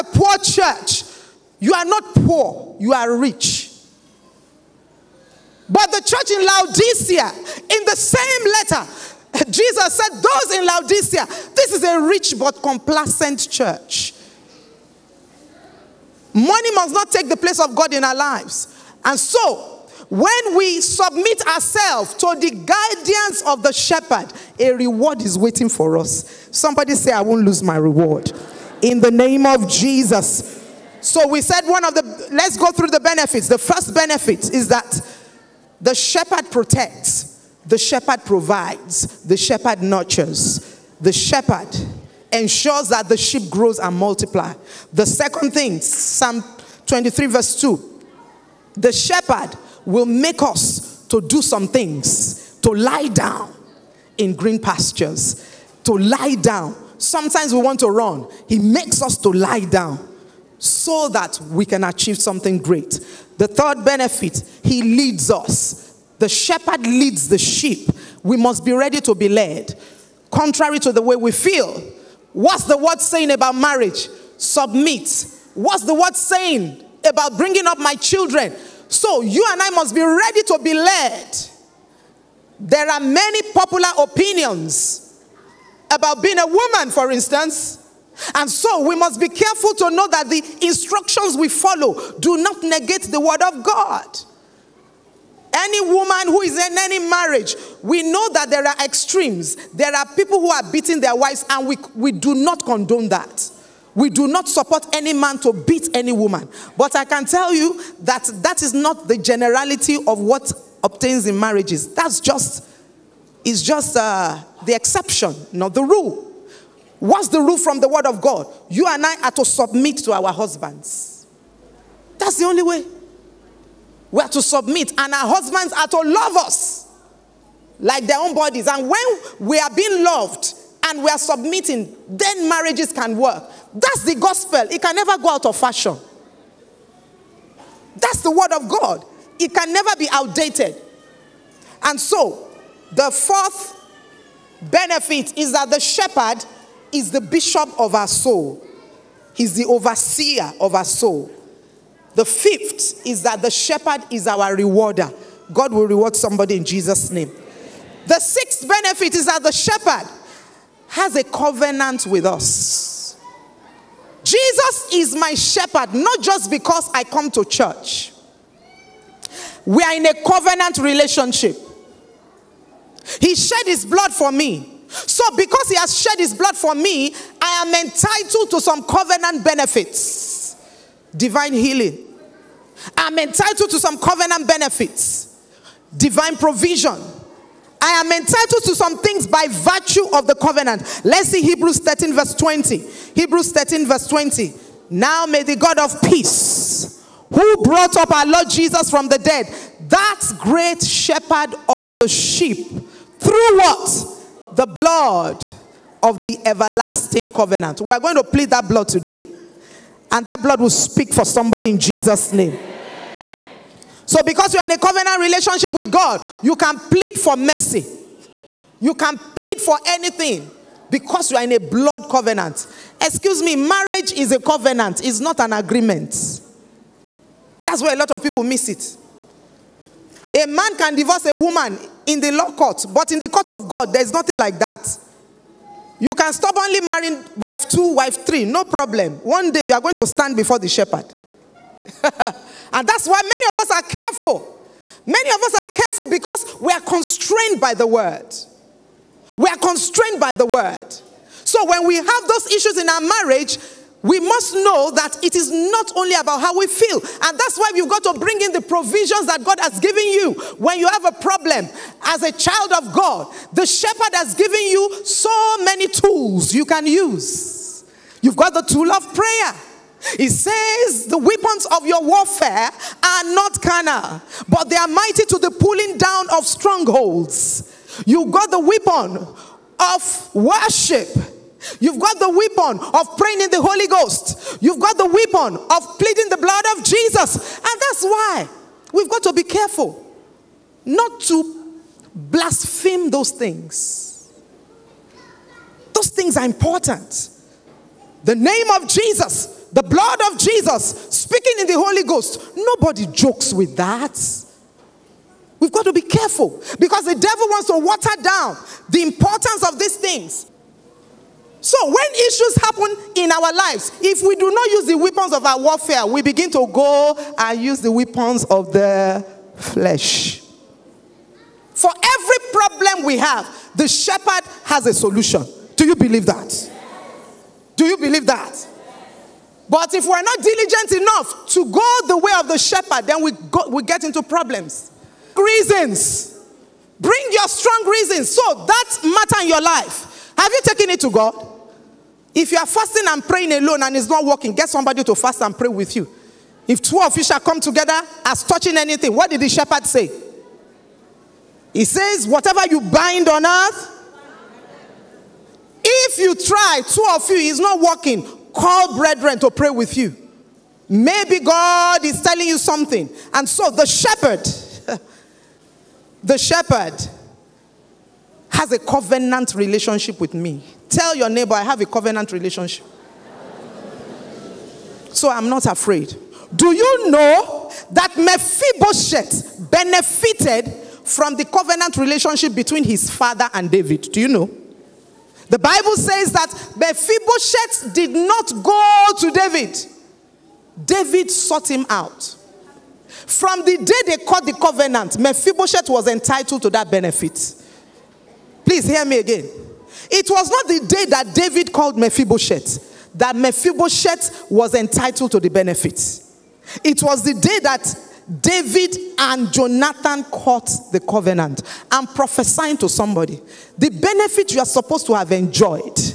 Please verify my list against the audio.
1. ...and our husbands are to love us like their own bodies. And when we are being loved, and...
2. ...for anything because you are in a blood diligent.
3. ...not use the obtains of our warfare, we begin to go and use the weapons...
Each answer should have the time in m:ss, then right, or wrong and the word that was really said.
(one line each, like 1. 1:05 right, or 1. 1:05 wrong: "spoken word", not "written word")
1. 2:04 right
2. 3:39 wrong: "covenant", not "diligent"
3. 5:14 wrong: "weapons", not "obtains".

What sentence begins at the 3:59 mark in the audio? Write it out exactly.
One day you are going to stand before the shepherd.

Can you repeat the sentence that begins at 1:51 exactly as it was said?
That's just, is just uh, the exception, not the rule.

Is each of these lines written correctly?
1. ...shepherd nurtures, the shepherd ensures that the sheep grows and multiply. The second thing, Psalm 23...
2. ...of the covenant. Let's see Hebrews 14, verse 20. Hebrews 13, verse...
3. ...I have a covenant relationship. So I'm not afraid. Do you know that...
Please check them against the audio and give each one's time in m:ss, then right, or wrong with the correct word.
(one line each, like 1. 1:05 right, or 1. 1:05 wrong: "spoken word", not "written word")
1. 0:39 right
2. 3:10 wrong: "13", not "14"
3. 6:11 right.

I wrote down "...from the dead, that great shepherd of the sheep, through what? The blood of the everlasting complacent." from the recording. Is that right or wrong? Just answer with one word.
wrong.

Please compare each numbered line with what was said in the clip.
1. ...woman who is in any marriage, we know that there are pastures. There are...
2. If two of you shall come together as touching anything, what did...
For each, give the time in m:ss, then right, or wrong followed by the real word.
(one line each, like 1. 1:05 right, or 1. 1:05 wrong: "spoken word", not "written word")
1. 1:35 wrong: "extremes", not "pastures"
2. 5:46 right.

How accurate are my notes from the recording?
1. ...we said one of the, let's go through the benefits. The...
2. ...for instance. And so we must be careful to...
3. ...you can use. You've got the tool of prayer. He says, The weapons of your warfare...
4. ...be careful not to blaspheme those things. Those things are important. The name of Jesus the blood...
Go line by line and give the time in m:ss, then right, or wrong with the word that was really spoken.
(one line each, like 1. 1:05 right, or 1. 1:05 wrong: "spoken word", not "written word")
1. 0:31 right
2. 1:26 right
3. 4:26 right
4. 4:49 right.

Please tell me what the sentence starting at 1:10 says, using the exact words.
Contrary to the way we feel, what's the word saying about marriage?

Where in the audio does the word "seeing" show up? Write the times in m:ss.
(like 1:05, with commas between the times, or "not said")
not said.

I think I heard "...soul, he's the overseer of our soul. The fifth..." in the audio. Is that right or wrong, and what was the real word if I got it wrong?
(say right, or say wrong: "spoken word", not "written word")
right.